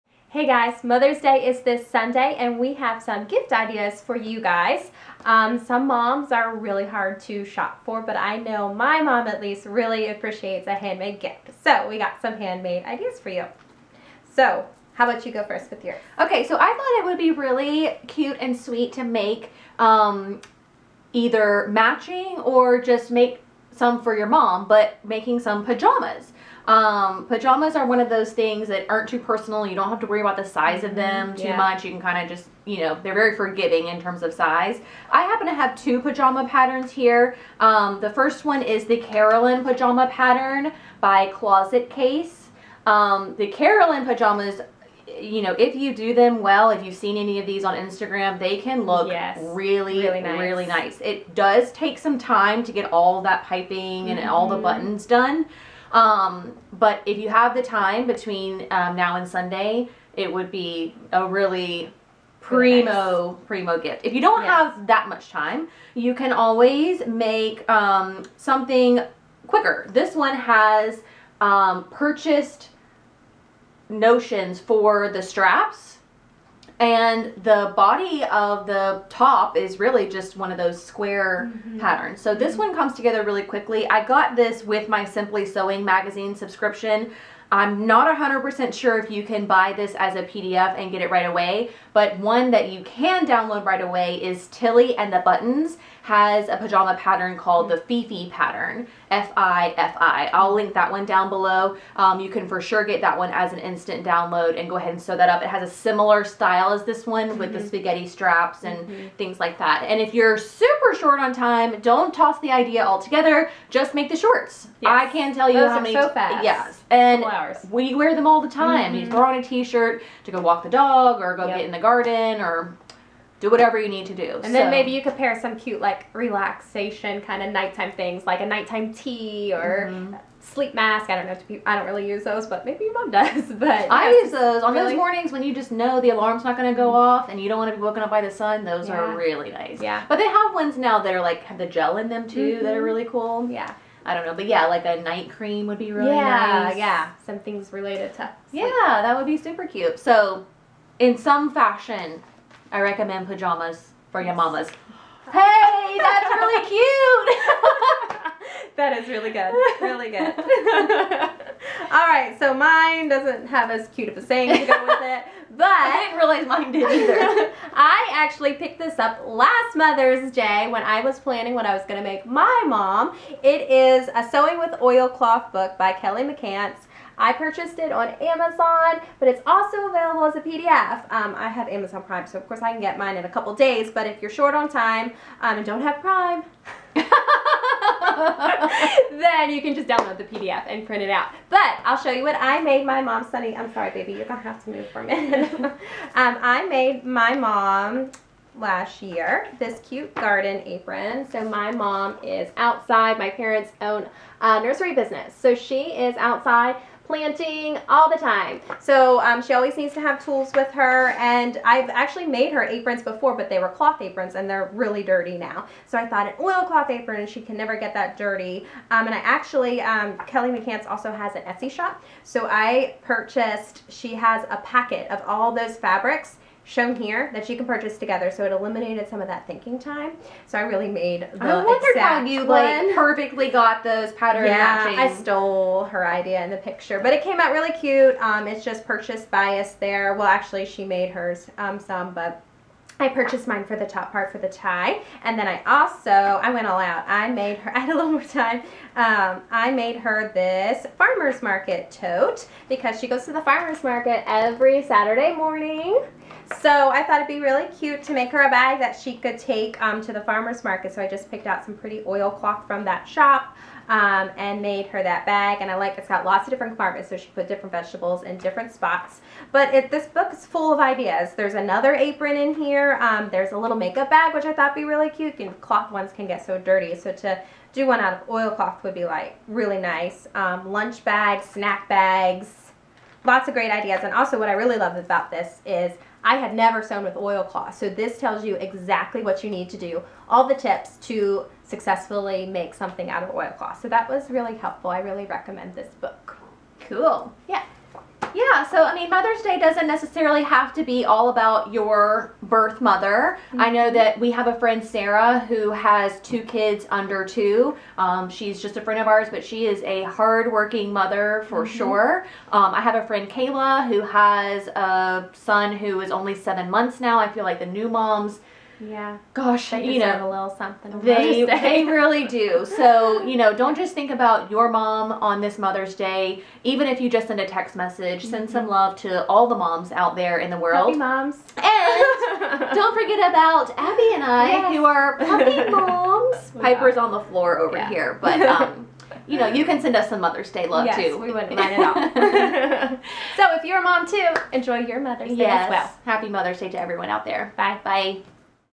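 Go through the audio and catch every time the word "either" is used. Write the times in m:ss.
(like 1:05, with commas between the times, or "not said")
0:21, 2:46.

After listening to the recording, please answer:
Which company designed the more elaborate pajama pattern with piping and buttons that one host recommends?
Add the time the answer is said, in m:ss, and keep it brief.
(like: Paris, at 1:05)
Closet Case, at 0:41.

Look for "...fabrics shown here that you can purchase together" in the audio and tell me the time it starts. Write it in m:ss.
3:45.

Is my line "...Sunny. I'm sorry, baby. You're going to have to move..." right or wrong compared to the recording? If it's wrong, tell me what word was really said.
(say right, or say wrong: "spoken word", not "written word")
right.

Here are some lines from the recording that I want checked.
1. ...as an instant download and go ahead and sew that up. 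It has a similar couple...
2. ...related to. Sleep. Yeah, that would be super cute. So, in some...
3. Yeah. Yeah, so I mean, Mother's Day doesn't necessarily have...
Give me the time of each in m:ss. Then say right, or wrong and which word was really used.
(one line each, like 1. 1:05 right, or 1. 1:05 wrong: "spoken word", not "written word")
1. 1:43 wrong: "style", not "couple"
2. 2:27 right
3. 4:57 right.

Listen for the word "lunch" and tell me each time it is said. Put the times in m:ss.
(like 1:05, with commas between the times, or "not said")
4:40.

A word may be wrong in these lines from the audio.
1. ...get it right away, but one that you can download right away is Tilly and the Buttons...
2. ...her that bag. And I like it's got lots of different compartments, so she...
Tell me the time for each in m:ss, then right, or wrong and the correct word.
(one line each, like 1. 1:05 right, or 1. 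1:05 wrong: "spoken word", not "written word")
1. 1:30 right
2. 4:24 right.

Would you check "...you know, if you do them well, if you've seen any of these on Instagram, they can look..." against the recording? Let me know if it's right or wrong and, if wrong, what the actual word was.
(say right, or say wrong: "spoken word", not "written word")
right.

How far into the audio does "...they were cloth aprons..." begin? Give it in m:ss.
3:33.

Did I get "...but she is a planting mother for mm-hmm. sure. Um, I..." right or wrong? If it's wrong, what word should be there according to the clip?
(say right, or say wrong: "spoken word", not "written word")
wrong: "hardworking", not "planting".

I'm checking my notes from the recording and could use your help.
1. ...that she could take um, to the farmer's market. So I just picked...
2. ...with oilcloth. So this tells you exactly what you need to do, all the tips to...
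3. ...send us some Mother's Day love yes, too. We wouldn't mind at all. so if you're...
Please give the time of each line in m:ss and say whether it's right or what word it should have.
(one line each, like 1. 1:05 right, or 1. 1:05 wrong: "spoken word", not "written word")
1. 4:18 right
2. 4:47 right
3. 5:39 right.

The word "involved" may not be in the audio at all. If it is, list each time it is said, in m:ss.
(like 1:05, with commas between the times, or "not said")
not said.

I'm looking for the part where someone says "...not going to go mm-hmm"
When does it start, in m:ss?
2:16.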